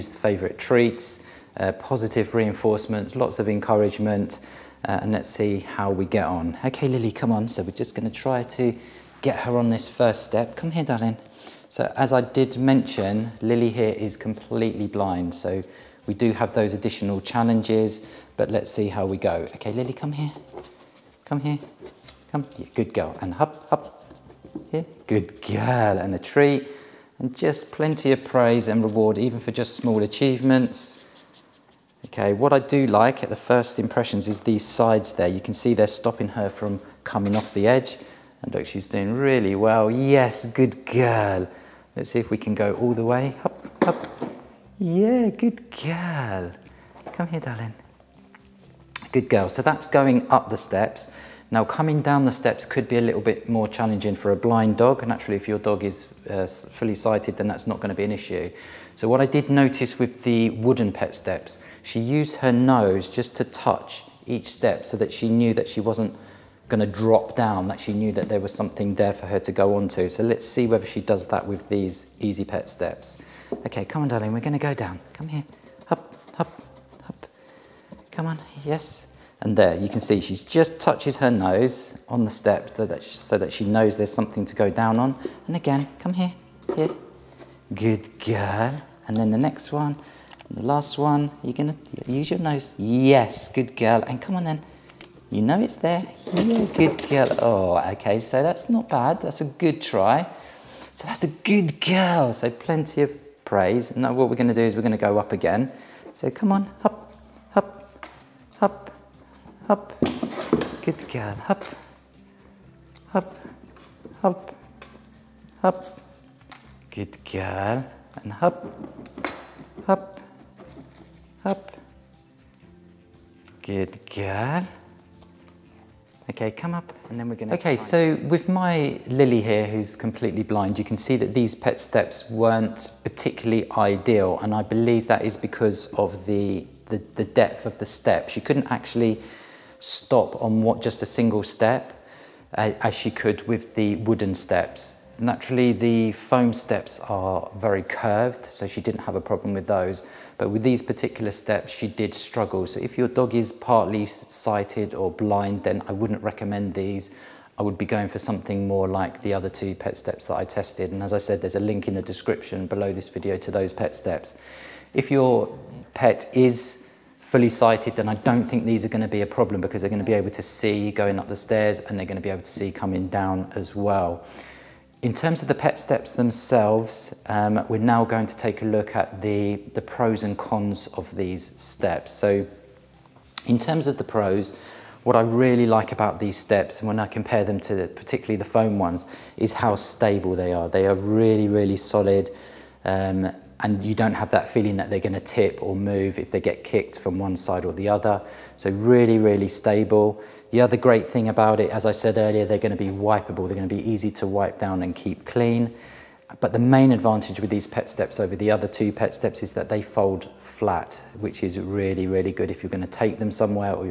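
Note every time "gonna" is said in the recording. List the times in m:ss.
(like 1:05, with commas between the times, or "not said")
0:07, 3:14.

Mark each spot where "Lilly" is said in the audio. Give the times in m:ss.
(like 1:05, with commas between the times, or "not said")
0:06, 0:13, 0:19, 2:09.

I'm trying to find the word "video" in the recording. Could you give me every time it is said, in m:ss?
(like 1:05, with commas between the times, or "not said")
2:43.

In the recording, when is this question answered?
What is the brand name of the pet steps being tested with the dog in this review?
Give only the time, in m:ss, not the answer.
1:12.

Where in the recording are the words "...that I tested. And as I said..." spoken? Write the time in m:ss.
2:40.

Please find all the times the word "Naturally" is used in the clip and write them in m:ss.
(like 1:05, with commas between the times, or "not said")
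0:55, 2:25.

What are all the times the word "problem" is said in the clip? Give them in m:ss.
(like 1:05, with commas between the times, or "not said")
2:29, 2:49.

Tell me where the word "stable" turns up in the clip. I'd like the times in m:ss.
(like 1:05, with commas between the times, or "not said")
3:09, 3:19.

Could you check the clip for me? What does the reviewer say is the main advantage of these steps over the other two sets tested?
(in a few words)
They fold flat.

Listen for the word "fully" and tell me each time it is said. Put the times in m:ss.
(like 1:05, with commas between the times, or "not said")
0:56, 2:47.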